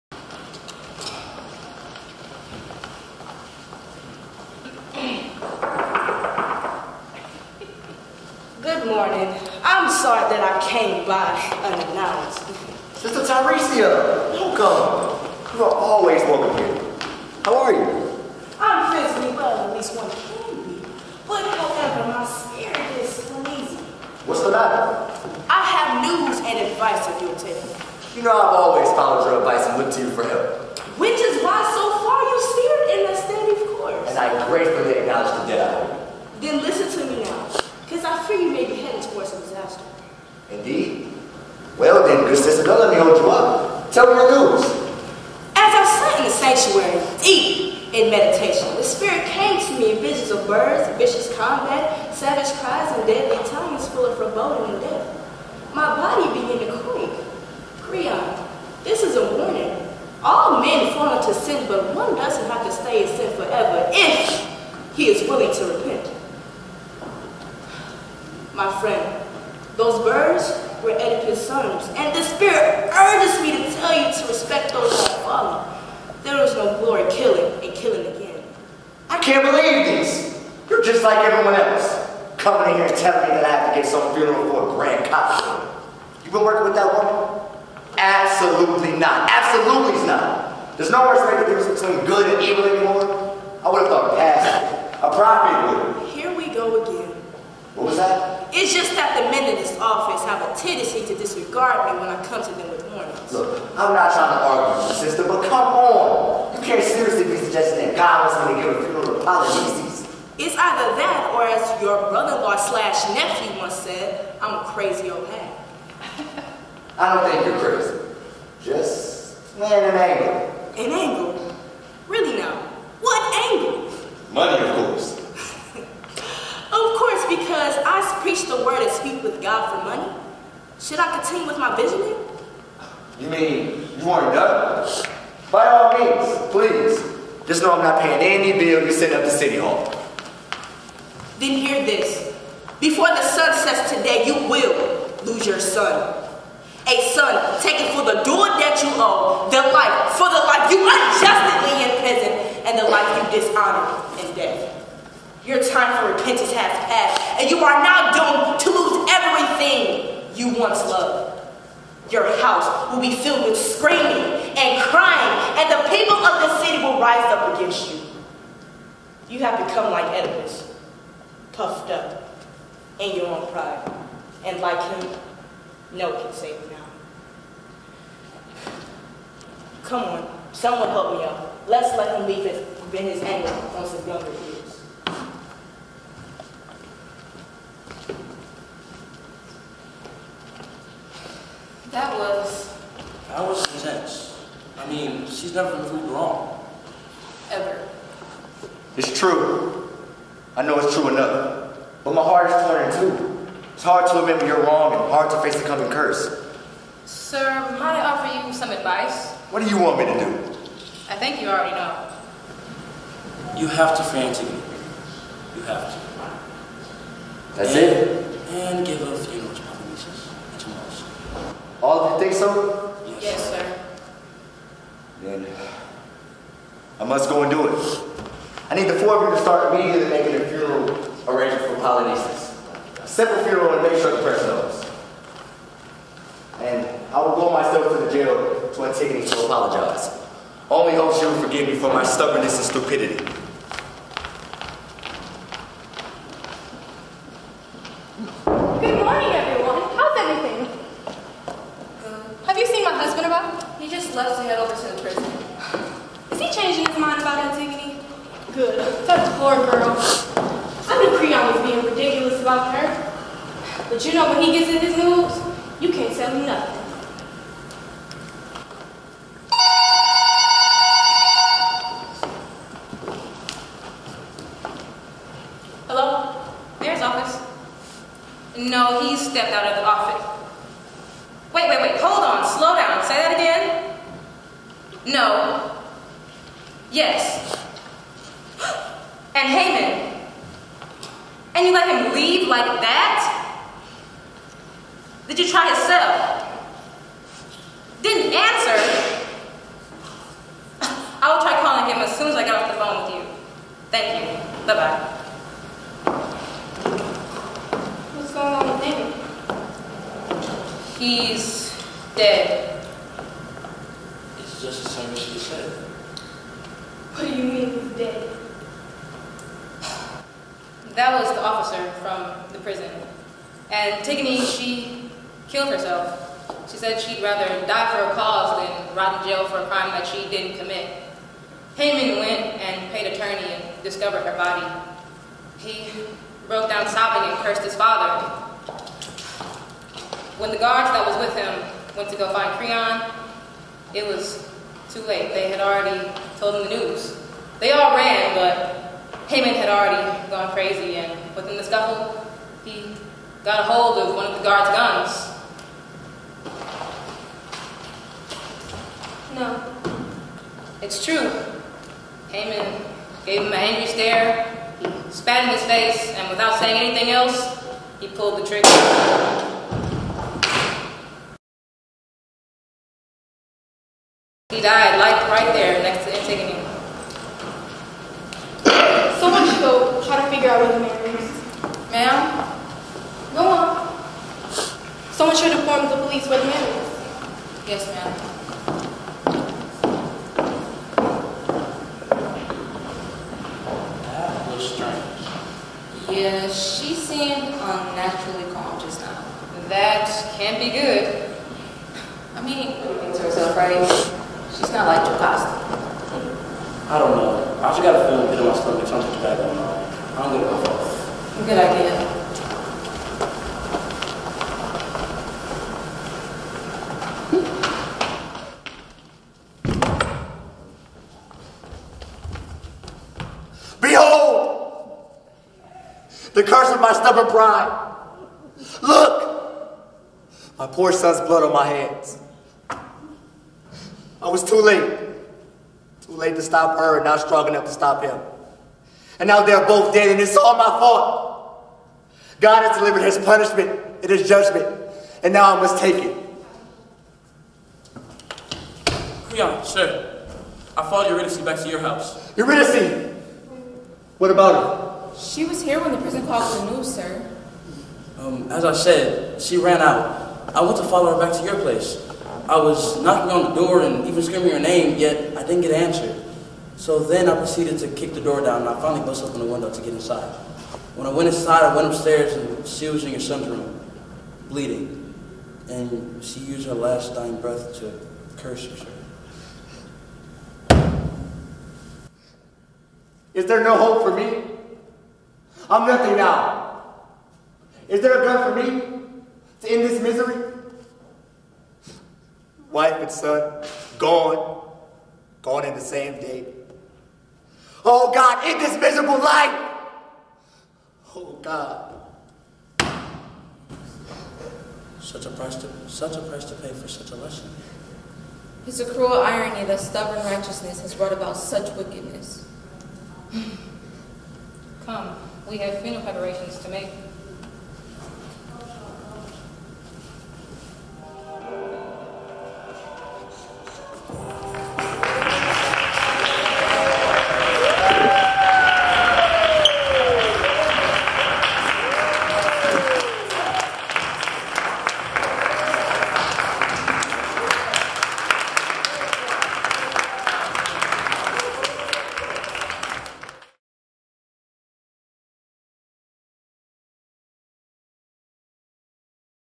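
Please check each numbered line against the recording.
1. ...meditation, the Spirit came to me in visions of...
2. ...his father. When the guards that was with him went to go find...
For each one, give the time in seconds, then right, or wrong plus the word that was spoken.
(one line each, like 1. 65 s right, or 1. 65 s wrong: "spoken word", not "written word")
1. 48 s right
2. 337 s right.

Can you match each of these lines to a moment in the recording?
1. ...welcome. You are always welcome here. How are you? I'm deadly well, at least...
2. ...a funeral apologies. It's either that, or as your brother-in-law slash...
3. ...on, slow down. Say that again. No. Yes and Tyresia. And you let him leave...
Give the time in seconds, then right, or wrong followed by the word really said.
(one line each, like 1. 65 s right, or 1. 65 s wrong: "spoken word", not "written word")
1. 14 s wrong: "physically", not "deadly"
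2. 108 s right
3. 282 s wrong: "Haemon", not "Tyresia".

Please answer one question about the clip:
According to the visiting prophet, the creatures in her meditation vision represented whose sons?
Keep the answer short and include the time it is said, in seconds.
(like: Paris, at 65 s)
Oedipus, at 69 s.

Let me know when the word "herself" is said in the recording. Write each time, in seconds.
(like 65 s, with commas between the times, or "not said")
325 s, 403 s, 478 s.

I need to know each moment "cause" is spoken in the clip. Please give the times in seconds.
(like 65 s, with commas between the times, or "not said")
328 s.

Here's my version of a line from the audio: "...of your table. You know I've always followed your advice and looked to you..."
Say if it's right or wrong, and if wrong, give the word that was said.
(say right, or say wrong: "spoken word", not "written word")
right.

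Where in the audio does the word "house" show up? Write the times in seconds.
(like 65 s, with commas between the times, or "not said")
162 s, 451 s.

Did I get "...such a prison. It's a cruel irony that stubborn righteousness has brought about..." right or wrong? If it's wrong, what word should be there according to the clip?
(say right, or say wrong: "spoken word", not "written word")
wrong: "lesson", not "prison".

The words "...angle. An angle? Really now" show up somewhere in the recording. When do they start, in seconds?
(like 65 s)
119 s.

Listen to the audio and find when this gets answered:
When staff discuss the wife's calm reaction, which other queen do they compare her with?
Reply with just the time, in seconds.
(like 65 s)
404 s.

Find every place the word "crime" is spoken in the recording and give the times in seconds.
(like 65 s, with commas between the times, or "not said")
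329 s.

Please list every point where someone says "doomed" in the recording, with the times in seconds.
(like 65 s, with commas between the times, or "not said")
158 s.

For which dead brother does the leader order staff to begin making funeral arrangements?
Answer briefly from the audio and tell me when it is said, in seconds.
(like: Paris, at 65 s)
Polynices, at 231 s.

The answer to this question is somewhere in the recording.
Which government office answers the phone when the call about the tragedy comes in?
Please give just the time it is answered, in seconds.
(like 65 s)
276 s.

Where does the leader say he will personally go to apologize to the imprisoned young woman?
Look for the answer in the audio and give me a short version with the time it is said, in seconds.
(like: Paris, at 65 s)
The jail, at 237 s.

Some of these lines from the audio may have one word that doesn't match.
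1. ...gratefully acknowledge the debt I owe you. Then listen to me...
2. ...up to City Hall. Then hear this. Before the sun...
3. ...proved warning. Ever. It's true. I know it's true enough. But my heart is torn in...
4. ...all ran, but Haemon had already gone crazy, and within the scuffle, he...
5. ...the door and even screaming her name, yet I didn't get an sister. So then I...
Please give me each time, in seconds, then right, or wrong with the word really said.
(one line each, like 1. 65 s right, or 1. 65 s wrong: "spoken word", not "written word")
1. 34 s right
2. 139 s right
3. 195 s wrong: "wrong", not "warning"
4. 347 s right
5. 463 s wrong: "answer", not "sister".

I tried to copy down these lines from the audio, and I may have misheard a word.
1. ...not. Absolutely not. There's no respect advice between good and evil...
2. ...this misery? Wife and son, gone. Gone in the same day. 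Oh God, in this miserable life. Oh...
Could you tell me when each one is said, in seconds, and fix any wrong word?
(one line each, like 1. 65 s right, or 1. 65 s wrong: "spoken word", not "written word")
1. 88 s wrong: "difference", not "advice"
2. 489 s right.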